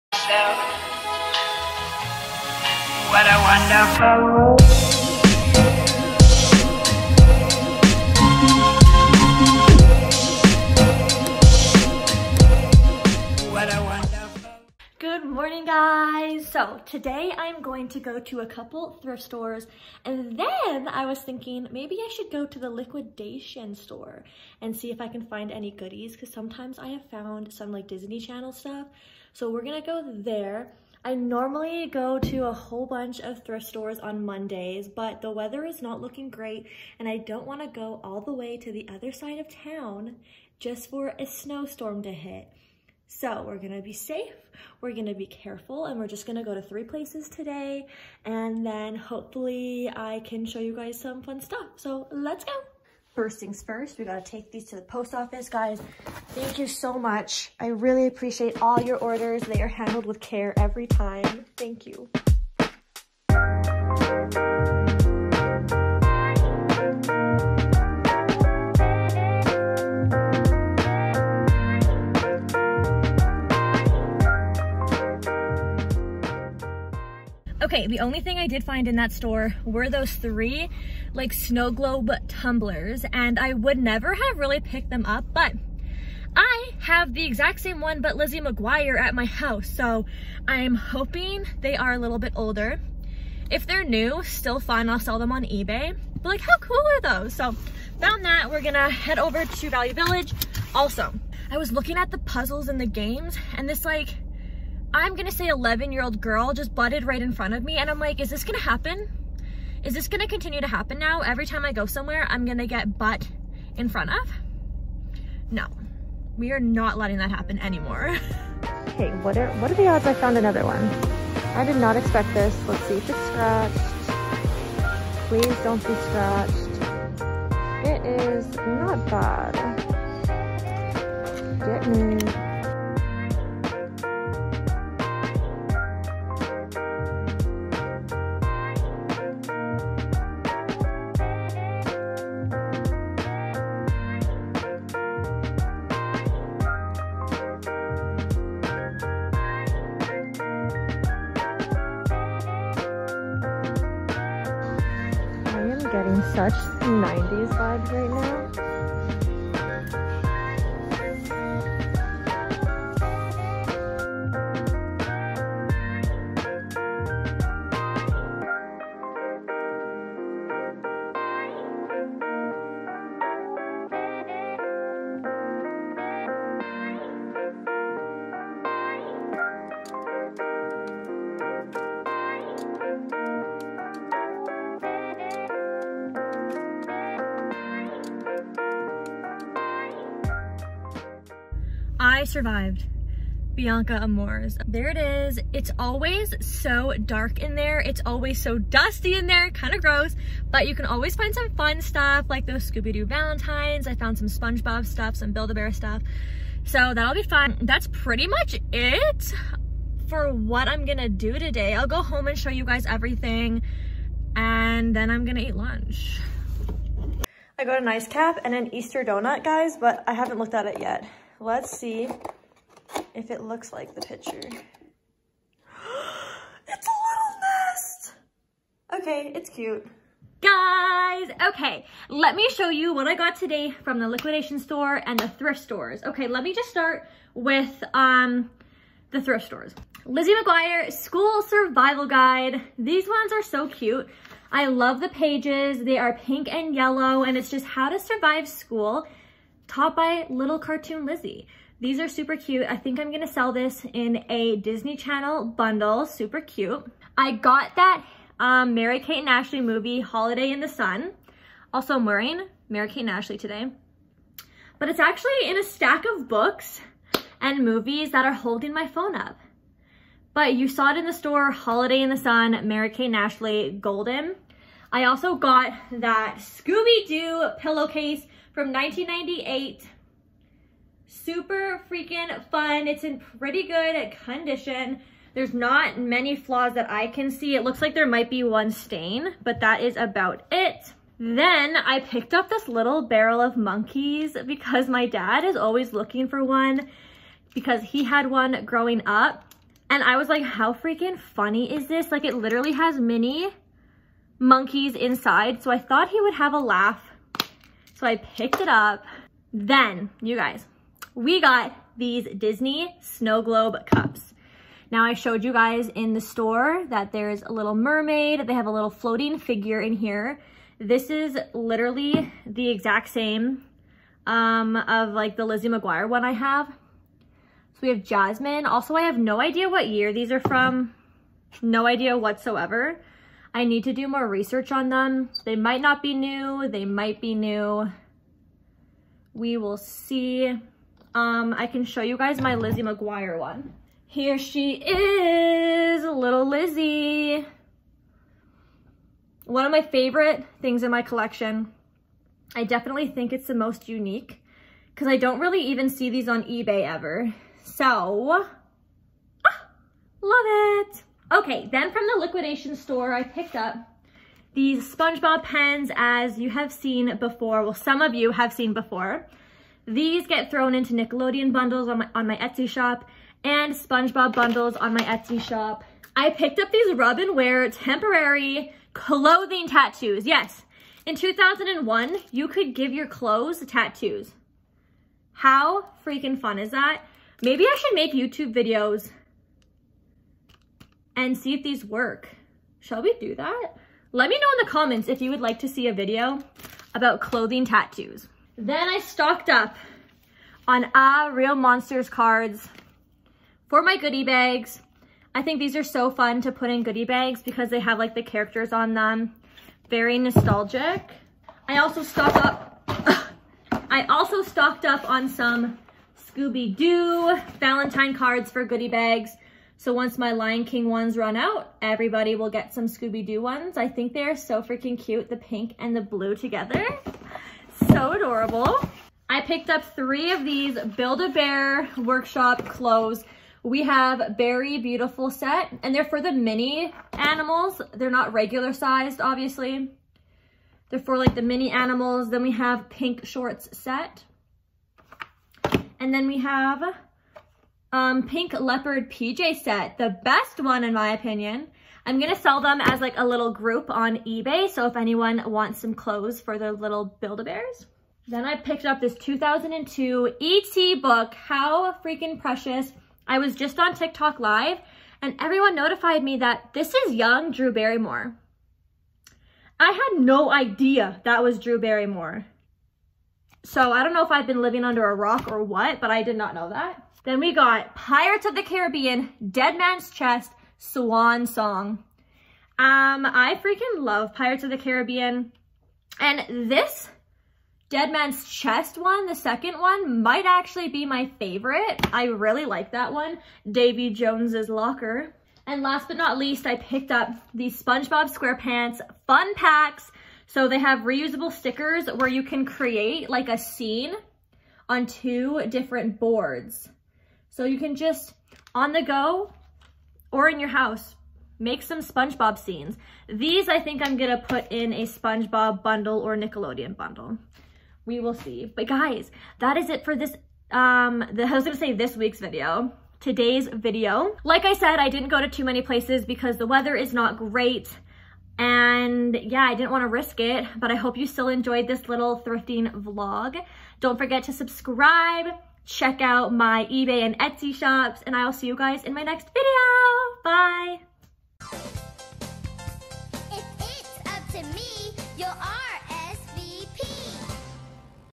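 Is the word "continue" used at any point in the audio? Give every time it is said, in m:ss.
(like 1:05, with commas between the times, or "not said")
1:50.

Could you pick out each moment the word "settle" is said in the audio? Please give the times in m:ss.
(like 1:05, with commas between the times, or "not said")
not said.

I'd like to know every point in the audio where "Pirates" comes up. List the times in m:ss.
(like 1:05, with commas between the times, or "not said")
7:57, 8:04.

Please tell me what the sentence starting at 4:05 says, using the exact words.
They are pink and yellow, and it's just how to survive school taught by little cartoon Lizzie.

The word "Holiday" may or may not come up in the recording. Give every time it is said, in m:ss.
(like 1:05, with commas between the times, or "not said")
4:20, 4:31.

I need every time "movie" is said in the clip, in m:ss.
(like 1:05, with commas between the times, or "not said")
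4:19, 4:27.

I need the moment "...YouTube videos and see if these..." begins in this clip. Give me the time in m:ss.
6:28.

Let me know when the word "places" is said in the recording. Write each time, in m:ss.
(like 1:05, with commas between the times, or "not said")
0:46, 8:45.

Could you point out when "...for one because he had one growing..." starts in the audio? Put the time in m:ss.
4:56.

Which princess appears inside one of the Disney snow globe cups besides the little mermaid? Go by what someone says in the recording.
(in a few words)
Jasmine.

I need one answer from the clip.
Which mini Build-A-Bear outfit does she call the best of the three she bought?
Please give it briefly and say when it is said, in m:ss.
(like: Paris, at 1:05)
Pink Leopard PJ set, at 7:28.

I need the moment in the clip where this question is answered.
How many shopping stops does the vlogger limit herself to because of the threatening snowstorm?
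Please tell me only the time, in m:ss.
0:46.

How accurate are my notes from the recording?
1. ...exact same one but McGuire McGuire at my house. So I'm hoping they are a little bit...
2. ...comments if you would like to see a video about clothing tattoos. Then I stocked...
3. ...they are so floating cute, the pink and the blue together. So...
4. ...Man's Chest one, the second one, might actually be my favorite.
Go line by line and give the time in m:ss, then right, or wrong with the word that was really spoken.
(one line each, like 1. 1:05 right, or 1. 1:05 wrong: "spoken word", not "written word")
1. 1:27 wrong: "Lizzie", not "McGuire"
2. 6:34 right
3. 7:04 wrong: "freaking", not "floating"
4. 8:08 right.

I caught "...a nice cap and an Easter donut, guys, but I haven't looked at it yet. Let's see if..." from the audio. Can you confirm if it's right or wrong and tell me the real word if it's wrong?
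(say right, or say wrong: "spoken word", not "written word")
right.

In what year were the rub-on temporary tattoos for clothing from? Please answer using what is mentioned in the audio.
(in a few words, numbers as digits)
2001.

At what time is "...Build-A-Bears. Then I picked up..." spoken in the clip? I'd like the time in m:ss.
7:37.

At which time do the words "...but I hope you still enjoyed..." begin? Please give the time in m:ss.
8:50.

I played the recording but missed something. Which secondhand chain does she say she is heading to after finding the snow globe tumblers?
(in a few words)
Value Village.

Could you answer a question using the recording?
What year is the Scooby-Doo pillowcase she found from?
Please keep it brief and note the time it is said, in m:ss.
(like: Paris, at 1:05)
1998, at 4:38.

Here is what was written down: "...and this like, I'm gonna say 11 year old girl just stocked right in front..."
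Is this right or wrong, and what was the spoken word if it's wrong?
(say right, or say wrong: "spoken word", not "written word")
wrong: "butted", not "stocked".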